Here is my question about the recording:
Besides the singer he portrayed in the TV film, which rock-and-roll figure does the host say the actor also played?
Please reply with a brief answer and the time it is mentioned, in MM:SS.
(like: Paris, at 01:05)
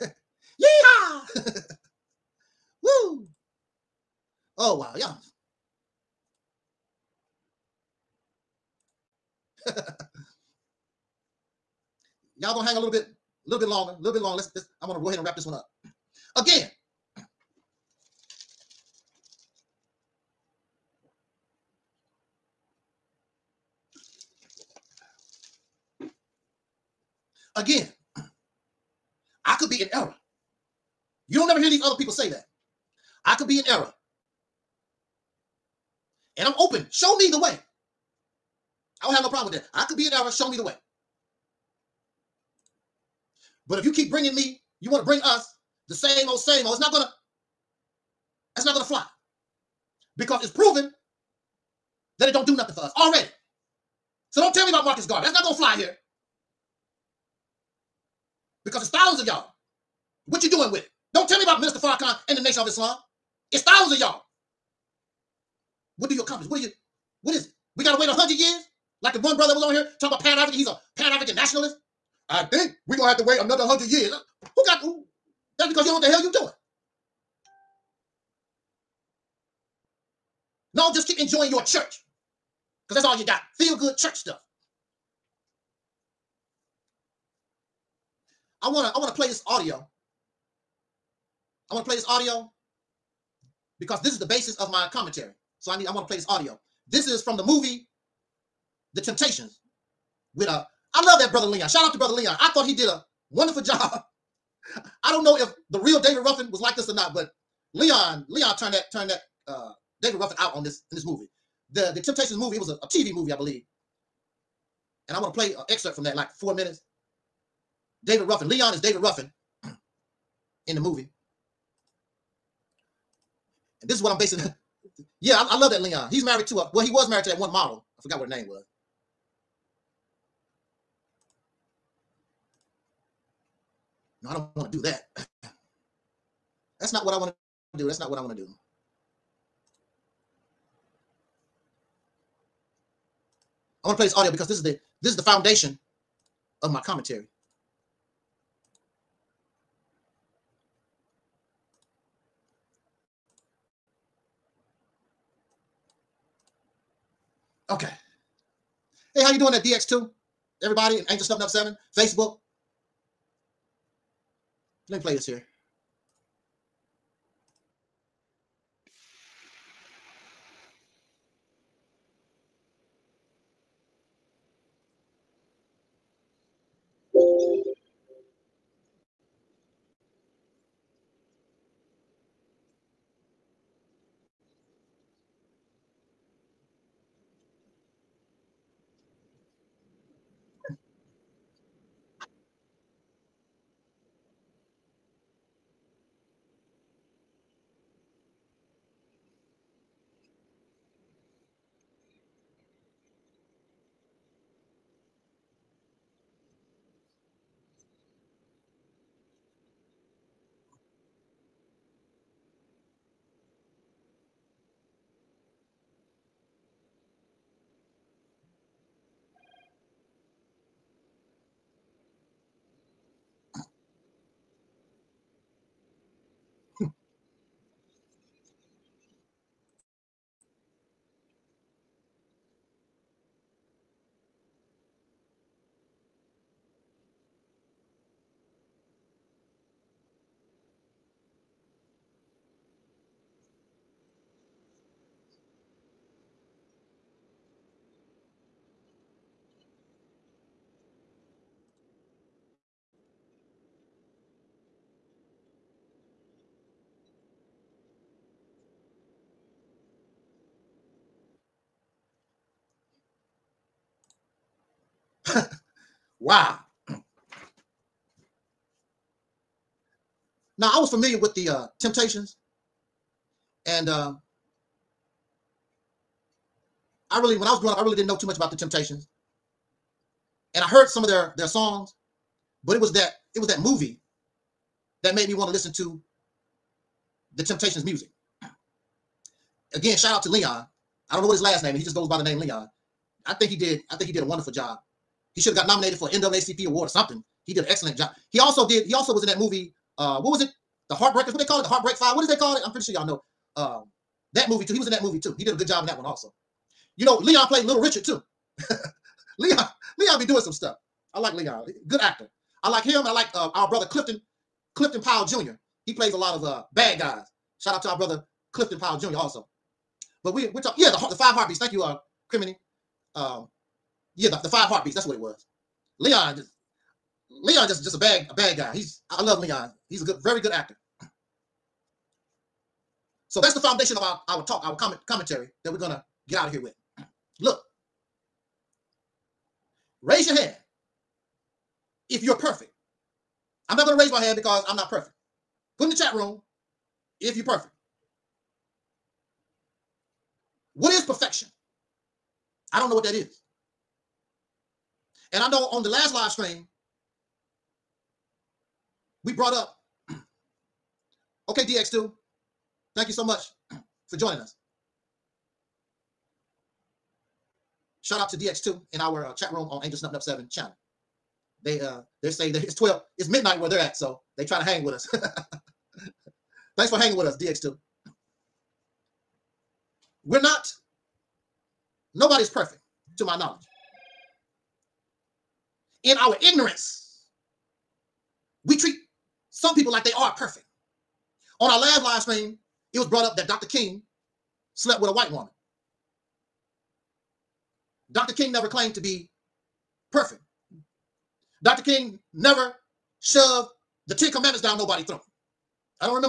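Little Richard, at 05:07.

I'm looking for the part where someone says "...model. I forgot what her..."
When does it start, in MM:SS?
02:07.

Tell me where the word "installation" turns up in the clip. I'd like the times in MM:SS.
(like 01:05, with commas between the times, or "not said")
not said.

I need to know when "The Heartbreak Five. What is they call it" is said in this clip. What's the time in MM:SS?
05:01.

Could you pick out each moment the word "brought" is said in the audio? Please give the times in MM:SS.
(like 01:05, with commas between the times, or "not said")
05:59, 06:33.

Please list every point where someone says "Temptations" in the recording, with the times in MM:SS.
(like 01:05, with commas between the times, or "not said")
01:39, 01:52, 04:31, 04:38, 04:47.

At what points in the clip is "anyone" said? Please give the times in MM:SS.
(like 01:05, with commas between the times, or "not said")
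not said.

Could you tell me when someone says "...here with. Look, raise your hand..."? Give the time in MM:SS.
05:36.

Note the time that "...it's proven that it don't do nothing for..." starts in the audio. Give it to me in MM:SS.
00:50.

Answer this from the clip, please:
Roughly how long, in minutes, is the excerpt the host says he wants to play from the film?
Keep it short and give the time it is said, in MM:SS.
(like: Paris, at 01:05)
4, at 01:56.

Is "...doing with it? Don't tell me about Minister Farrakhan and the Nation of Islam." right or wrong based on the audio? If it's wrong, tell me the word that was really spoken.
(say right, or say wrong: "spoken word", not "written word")
right.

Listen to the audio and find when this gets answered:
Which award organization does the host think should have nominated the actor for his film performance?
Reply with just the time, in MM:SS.
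04:56.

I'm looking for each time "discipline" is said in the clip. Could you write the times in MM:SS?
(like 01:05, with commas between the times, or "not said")
not said.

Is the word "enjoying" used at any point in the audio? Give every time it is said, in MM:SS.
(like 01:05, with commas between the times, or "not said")
01:21.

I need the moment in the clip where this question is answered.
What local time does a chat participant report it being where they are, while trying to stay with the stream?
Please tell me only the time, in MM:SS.
06:13.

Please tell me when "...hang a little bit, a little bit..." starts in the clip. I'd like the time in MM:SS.
00:12.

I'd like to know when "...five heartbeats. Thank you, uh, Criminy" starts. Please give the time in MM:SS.
05:21.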